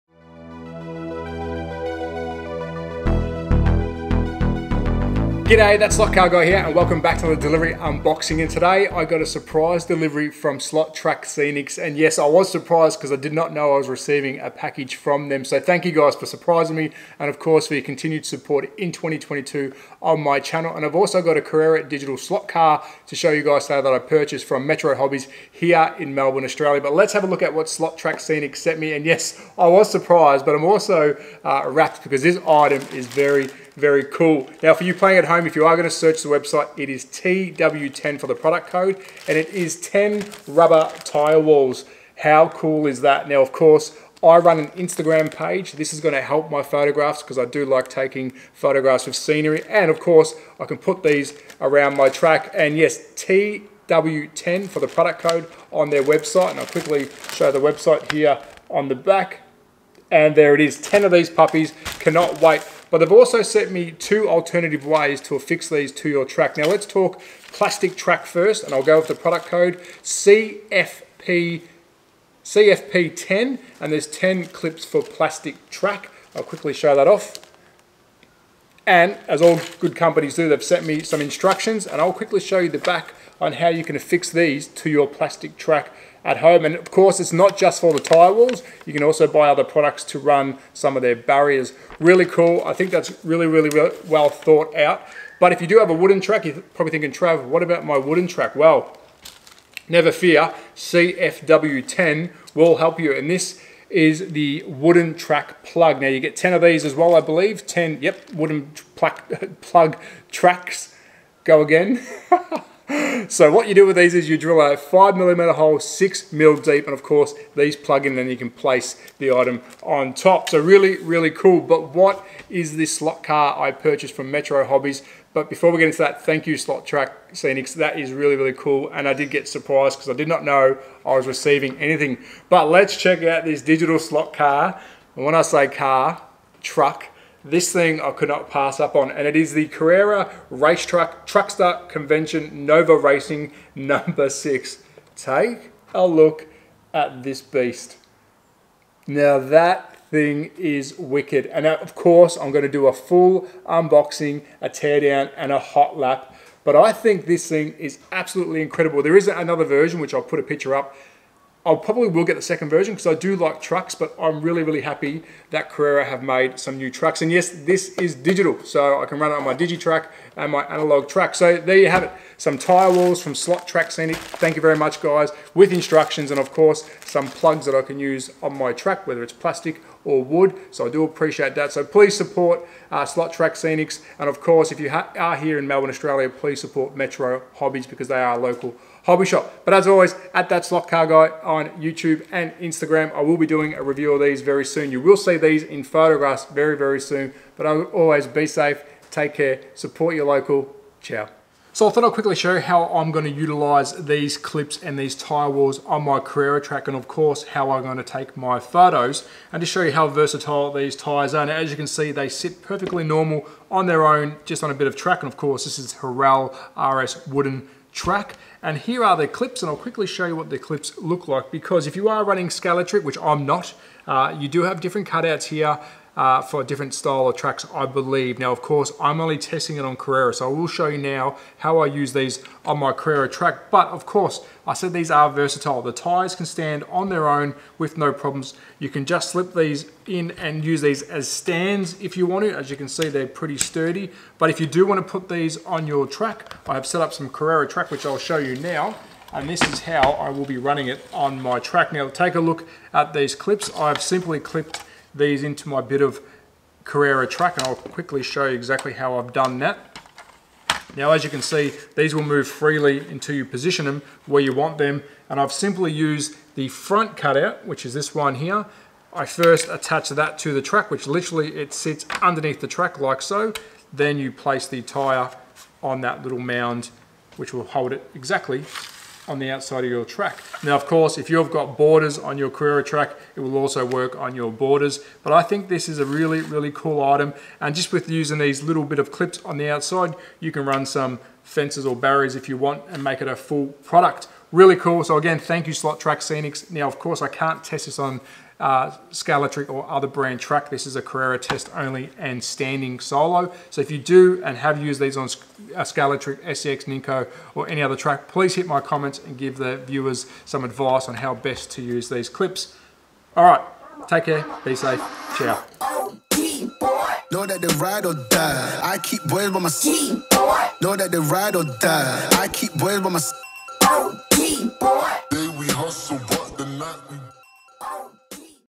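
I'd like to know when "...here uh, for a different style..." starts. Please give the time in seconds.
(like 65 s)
225 s.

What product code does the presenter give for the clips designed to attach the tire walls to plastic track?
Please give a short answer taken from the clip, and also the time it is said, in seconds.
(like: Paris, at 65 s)
CFP10, at 72 s.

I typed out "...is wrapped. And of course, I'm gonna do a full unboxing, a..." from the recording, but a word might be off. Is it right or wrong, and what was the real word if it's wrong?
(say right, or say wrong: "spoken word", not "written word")
wrong: "wicked", not "wrapped".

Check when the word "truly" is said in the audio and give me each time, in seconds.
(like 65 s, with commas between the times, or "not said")
not said.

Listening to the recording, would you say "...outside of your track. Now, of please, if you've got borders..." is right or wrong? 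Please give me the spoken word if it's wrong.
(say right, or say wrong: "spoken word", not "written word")
wrong: "course", not "please".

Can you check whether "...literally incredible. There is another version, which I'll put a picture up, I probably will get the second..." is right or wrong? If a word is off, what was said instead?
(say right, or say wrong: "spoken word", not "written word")
wrong: "absolutely", not "literally".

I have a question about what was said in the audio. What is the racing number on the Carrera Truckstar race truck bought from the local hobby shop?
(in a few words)
6.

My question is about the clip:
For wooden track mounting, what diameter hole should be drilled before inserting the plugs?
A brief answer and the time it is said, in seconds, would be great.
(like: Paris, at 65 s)
5 millimeters, at 114 s.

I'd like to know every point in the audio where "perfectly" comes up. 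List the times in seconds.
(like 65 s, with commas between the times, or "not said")
212 s.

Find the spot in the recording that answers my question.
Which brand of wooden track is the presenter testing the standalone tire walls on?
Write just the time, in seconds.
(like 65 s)
215 s.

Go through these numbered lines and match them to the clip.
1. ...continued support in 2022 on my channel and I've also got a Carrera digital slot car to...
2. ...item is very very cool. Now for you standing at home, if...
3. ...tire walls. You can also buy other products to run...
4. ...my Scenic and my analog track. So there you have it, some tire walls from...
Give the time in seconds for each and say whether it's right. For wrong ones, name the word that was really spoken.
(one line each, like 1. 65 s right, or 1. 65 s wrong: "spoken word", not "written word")
1. 17 s right
2. 32 s wrong: "playing", not "standing"
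3. 87 s right
4. 169 s wrong: "Digitrack", not "Scenic".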